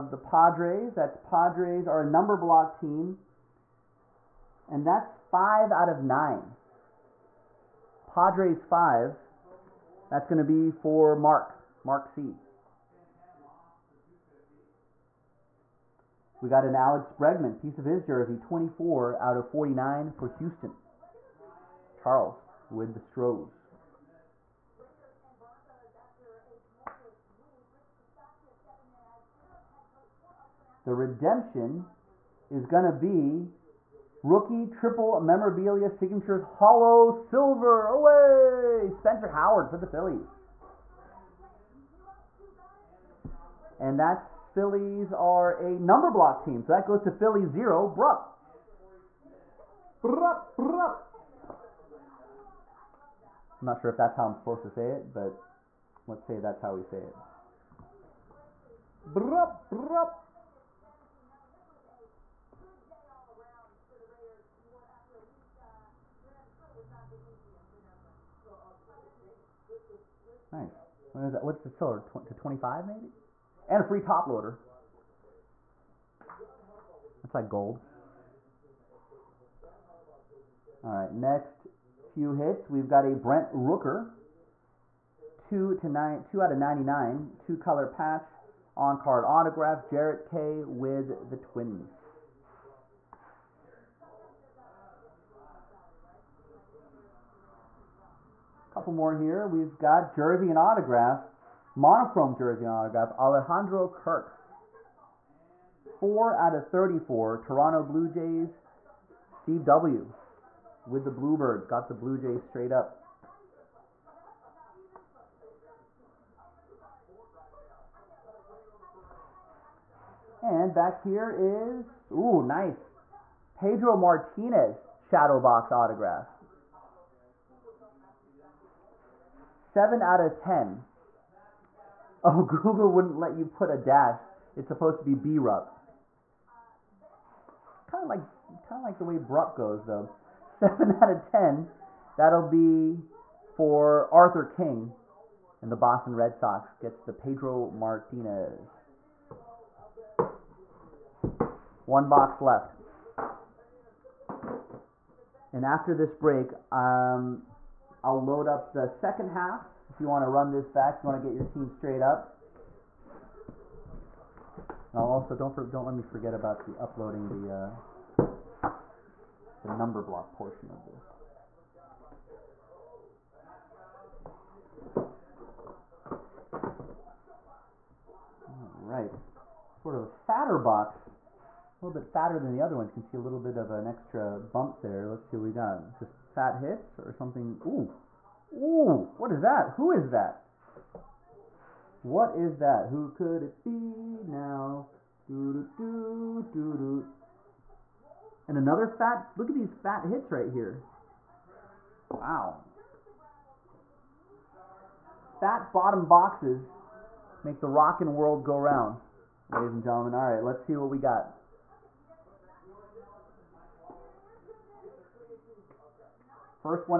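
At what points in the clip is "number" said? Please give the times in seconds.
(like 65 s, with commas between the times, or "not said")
2 s, 45 s, 169 s.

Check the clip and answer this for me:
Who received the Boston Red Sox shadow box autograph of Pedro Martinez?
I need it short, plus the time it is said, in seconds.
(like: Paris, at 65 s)
Arthur King, at 144 s.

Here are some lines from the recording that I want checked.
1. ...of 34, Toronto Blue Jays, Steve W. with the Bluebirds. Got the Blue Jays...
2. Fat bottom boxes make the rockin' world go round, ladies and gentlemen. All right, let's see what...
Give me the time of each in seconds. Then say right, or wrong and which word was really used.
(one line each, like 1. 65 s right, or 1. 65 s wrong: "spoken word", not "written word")
1. 106 s right
2. 205 s right.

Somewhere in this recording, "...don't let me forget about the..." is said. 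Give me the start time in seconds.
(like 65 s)
165 s.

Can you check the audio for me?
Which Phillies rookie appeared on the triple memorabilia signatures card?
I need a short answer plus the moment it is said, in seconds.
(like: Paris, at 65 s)
Spencer Howard, at 38 s.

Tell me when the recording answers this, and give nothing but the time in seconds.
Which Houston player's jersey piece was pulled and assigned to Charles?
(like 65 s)
16 s.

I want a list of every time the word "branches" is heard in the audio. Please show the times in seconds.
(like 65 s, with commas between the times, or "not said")
not said.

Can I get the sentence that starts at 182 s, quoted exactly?
You can see a little bit of an extra bump there.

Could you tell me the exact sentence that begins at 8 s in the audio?
Padres five, that's going to be for Mark, Mark C.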